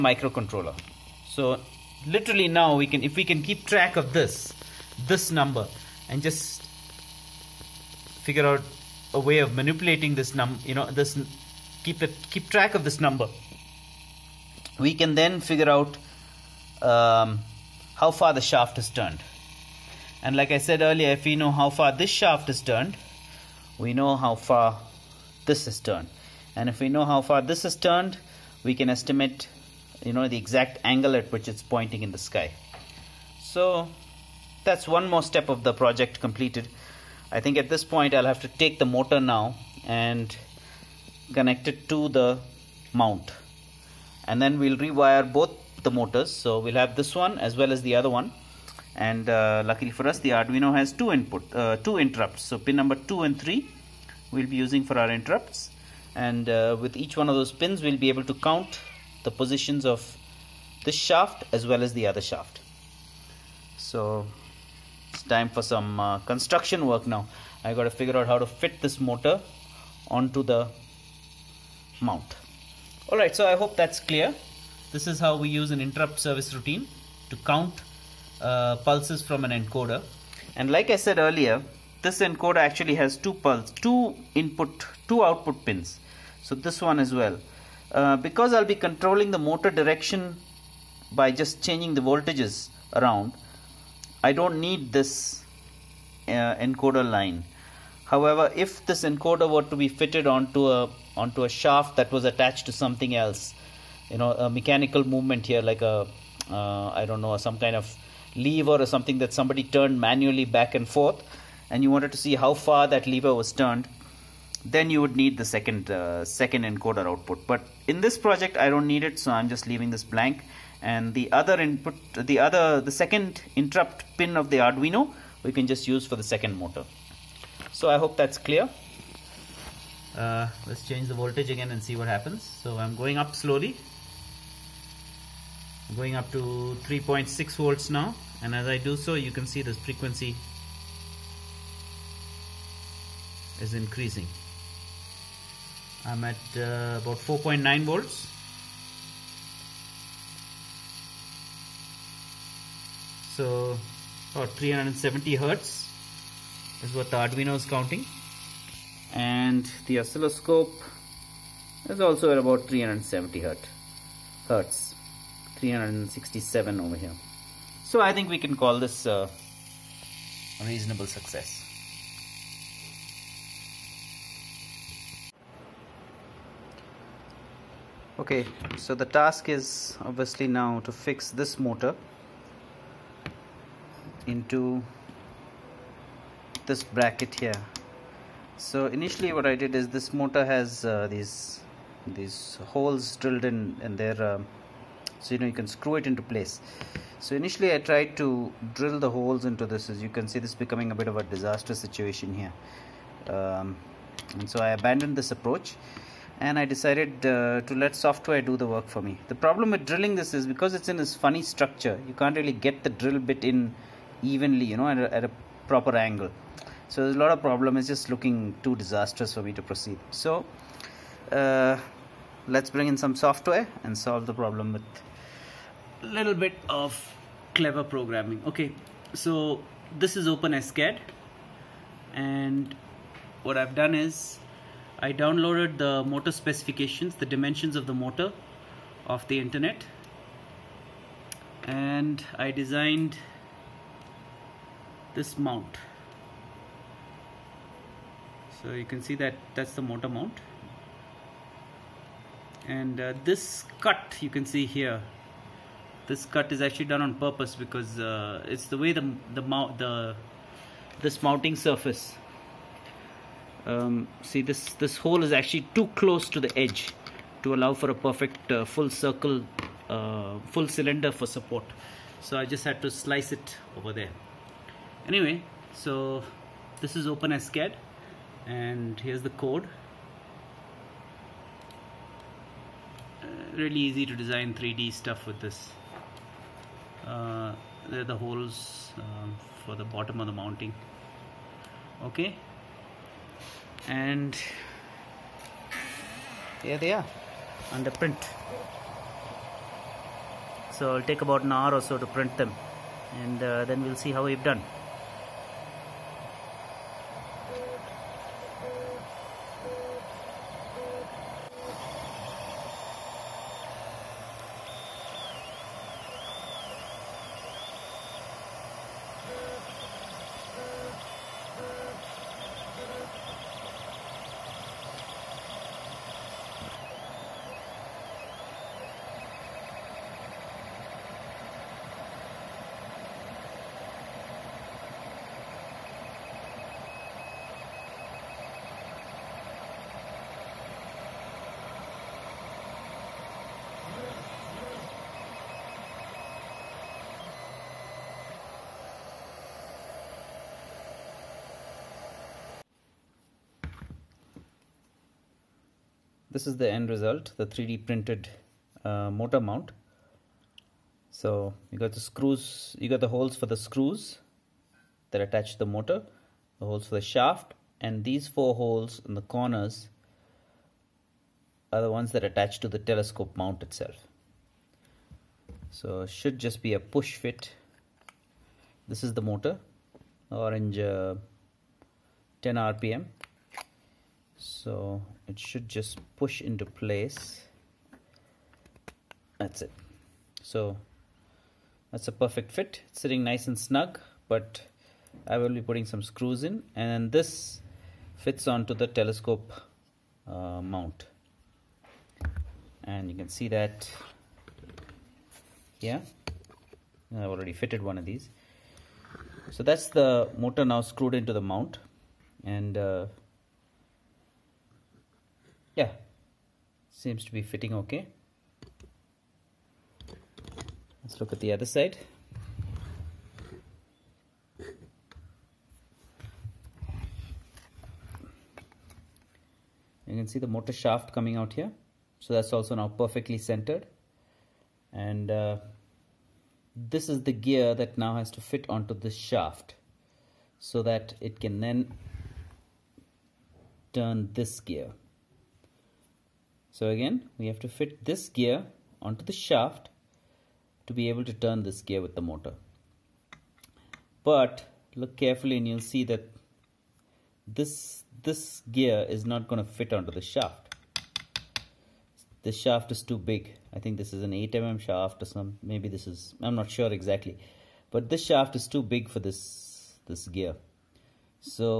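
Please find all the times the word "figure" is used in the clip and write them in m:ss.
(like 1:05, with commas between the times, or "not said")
0:08, 0:15, 1:08.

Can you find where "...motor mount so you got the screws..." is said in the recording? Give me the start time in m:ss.
5:59.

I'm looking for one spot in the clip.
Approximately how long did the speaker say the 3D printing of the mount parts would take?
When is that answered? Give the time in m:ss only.
5:01.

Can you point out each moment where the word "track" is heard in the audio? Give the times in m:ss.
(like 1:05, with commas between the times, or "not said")
0:03, 0:12.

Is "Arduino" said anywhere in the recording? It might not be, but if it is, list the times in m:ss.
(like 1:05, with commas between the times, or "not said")
0:50, 2:04, 2:37.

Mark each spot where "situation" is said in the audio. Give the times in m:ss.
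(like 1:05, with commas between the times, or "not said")
3:21.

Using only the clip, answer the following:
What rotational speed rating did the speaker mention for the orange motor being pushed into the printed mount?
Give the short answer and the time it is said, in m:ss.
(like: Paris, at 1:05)
10 rpm, at 6:22.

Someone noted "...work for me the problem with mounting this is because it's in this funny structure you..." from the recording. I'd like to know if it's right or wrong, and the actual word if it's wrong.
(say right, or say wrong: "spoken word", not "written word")
wrong: "drilling", not "mounting".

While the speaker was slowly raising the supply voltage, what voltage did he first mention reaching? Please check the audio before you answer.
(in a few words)
3.6 volts.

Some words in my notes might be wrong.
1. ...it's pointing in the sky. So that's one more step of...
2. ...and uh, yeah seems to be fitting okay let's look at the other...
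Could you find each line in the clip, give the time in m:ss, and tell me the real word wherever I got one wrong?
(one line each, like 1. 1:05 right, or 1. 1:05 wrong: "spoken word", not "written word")
1. 0:31 right
2. 6:52 right.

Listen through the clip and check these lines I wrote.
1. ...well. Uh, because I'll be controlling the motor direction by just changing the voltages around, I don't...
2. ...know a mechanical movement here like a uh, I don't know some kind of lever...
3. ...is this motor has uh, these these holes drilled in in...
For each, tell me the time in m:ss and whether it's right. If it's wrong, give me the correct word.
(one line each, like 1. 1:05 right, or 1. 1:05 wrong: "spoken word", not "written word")
1. 1:27 right
2. 1:44 right
3. 3:09 right.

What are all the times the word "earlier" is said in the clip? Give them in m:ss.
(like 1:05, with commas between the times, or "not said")
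0:20, 1:21.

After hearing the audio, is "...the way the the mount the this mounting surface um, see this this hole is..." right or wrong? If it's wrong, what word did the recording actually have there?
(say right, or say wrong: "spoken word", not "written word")
right.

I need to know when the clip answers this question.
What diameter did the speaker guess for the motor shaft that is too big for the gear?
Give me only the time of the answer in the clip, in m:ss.
7:44.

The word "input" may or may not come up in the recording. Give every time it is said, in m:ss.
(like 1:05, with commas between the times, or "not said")
0:51, 1:24, 2:01.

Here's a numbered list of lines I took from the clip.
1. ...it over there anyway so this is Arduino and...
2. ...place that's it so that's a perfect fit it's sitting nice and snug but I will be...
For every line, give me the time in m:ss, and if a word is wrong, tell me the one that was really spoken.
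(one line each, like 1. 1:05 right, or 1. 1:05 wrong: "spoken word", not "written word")
1. 4:33 wrong: "OpenSCAD", not "Arduino"
2. 6:26 right.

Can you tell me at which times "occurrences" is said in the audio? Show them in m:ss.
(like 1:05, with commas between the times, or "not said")
not said.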